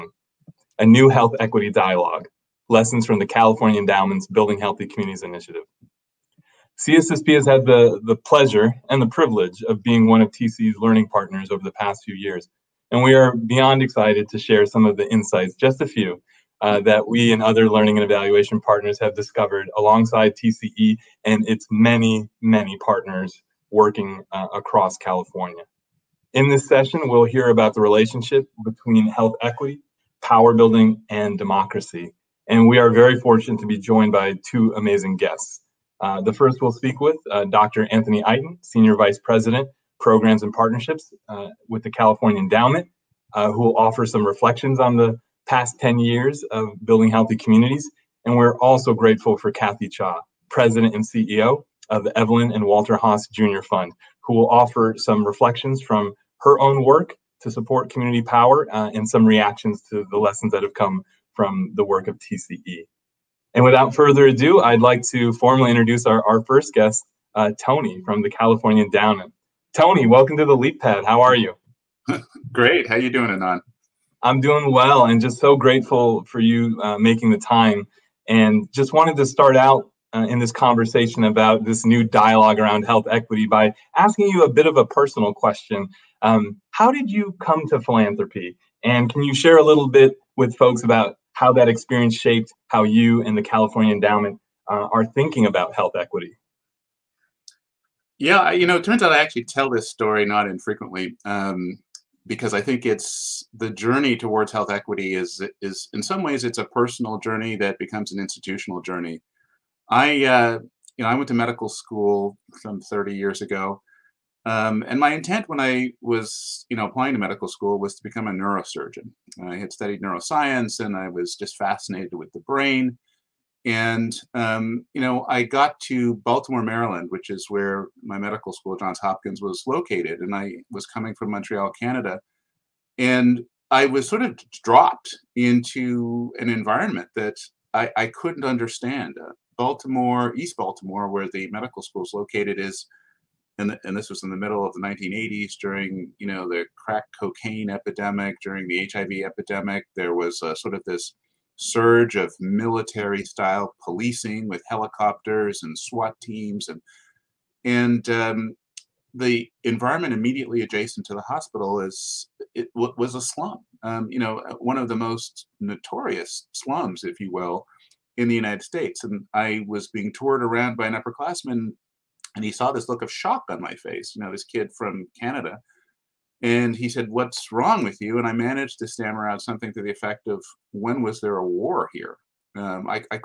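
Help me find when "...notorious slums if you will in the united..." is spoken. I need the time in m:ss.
2:45.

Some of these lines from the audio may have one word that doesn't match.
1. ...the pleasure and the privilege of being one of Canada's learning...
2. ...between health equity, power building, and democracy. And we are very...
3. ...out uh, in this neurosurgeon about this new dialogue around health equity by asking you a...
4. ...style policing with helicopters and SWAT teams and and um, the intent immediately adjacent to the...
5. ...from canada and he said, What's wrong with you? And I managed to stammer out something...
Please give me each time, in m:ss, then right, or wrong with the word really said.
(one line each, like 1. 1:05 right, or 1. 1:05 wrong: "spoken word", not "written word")
1. 0:08 wrong: "TCE", not "Canada"
2. 0:28 right
3. 1:19 wrong: "conversation", not "neurosurgeon"
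4. 2:33 wrong: "environment", not "intent"
5. 2:54 right.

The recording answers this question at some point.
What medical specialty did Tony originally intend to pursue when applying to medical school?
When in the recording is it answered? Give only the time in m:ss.
1:58.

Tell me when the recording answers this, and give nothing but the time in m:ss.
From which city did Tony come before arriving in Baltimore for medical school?
2:11.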